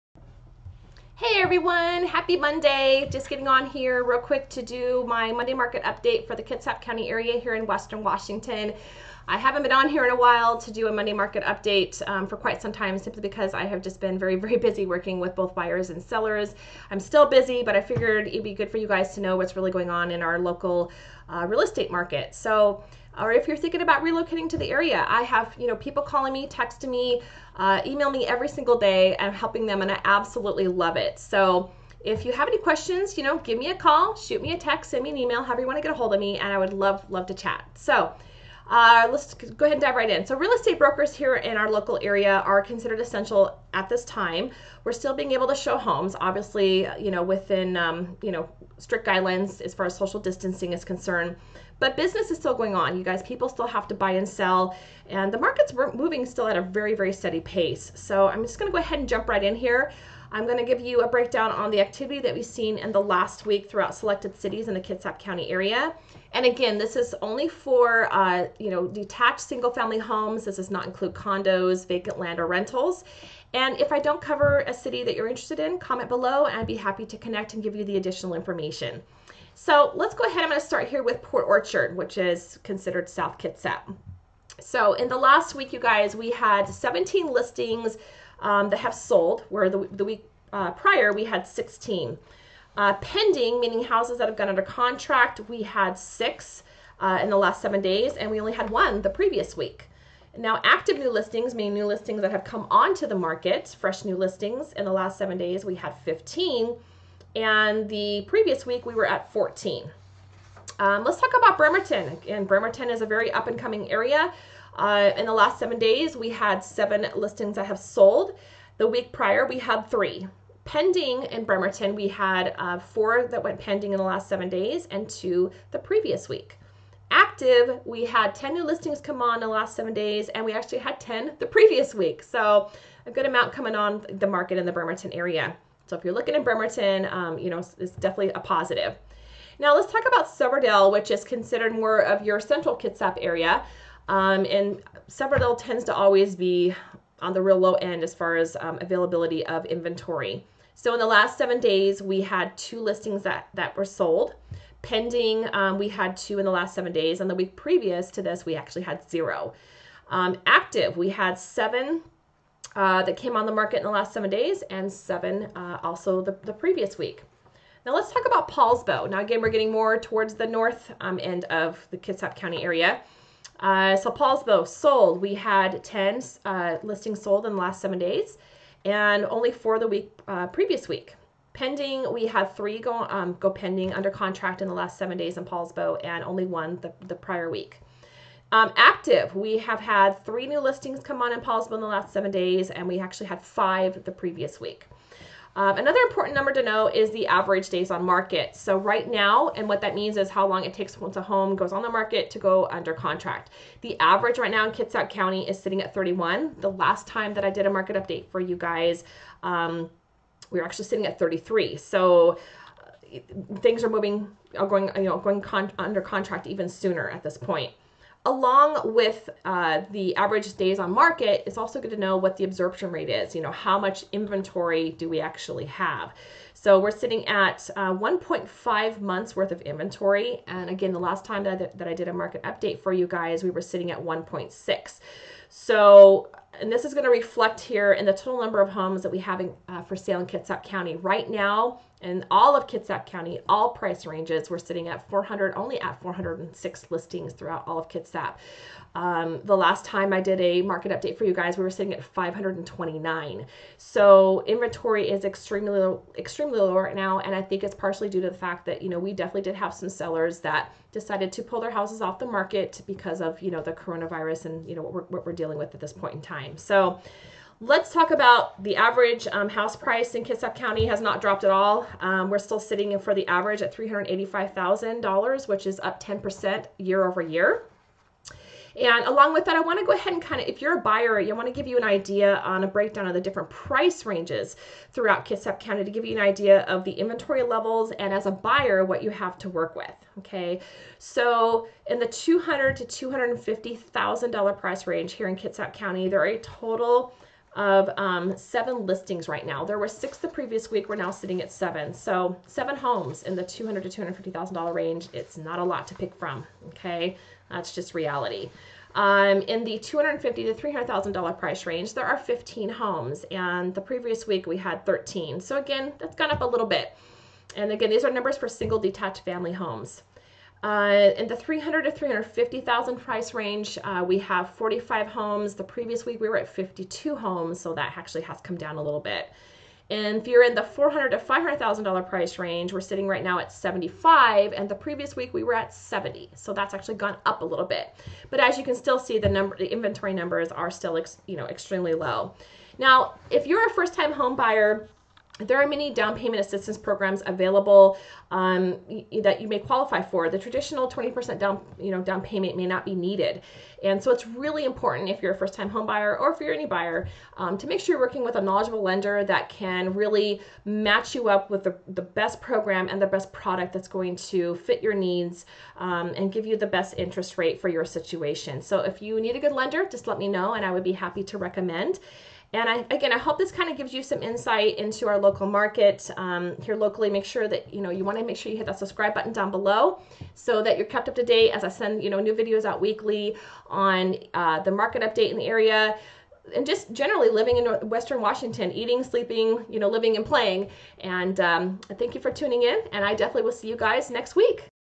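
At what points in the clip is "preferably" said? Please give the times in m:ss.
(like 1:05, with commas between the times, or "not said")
not said.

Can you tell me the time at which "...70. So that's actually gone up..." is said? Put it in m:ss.
5:35.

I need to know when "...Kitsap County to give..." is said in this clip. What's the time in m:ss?
4:45.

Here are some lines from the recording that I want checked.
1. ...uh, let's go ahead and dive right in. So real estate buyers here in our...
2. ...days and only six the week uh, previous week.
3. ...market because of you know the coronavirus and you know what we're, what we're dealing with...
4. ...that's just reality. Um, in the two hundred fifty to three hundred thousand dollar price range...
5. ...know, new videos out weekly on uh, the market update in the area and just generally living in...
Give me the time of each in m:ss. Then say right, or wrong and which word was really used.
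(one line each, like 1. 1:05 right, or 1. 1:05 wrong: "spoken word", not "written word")
1. 0:38 wrong: "brokers", not "buyers"
2. 2:57 wrong: "four", not "six"
3. 4:22 right
4. 5:07 right
5. 6:22 right.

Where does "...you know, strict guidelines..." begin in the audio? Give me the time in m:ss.
0:48.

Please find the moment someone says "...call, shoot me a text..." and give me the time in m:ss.
0:33.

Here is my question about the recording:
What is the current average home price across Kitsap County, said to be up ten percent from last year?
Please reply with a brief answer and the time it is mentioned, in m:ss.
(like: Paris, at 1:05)
$385,000, at 4:33.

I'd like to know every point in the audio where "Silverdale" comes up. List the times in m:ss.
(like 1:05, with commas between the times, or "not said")
2:20, 2:25.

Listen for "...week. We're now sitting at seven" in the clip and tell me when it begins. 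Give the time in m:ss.
5:00.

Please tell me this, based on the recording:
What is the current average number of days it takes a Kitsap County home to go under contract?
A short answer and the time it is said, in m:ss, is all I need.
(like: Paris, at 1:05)
31, at 3:25.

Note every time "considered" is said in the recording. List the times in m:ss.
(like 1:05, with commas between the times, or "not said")
0:42, 1:22, 2:21.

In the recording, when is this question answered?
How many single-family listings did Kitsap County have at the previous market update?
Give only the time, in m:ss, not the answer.
4:12.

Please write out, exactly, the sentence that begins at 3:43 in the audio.
You know, how much inventory do we actually have?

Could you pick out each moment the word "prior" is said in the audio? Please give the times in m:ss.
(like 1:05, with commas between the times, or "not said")
1:30, 1:59, 3:07.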